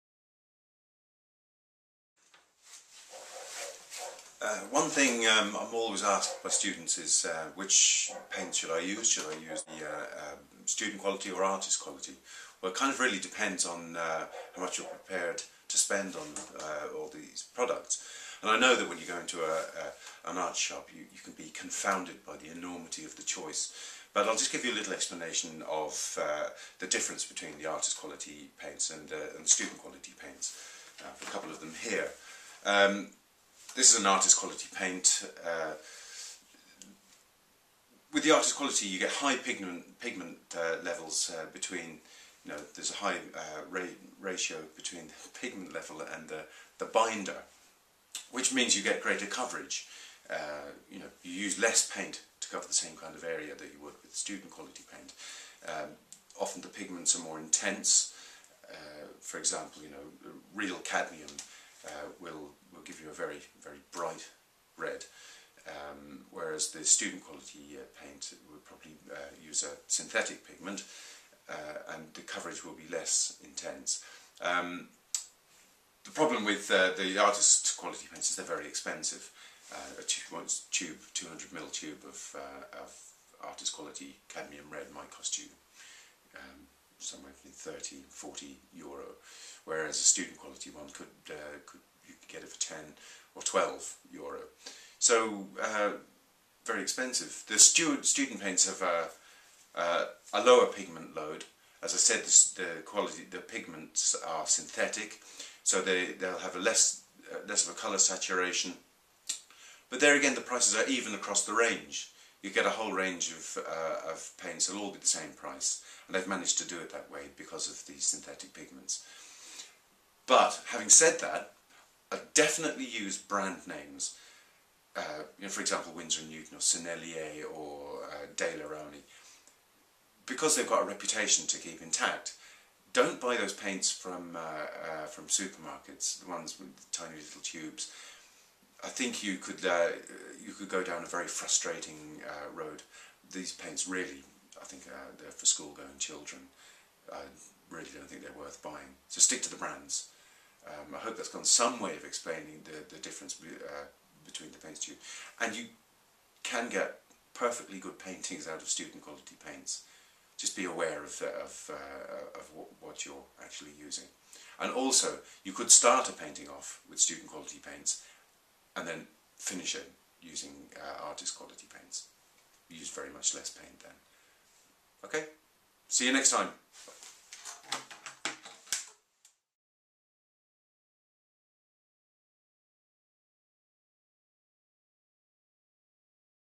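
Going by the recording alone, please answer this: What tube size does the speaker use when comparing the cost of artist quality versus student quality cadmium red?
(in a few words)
200 ml.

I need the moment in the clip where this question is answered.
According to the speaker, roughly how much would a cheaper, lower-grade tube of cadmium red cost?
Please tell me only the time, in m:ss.
1:32.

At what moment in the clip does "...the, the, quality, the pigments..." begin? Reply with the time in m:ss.
1:42.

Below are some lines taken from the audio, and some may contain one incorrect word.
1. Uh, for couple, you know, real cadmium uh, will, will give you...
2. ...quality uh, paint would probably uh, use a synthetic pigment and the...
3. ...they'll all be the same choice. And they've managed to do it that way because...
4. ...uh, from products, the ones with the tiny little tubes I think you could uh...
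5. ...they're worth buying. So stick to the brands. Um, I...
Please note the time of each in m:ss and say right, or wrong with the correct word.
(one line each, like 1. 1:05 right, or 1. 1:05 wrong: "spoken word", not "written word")
1. 0:58 wrong: "example", not "couple"
2. 1:07 right
3. 1:54 wrong: "price", not "choice"
4. 2:14 wrong: "supermarkets", not "products"
5. 2:28 right.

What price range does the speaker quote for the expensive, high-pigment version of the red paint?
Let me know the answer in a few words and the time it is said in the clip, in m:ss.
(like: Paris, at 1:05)
30 to 40 euro, at 1:27.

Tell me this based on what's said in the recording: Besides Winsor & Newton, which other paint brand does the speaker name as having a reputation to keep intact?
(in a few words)
Sennelier.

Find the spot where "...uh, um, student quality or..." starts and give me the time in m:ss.
0:09.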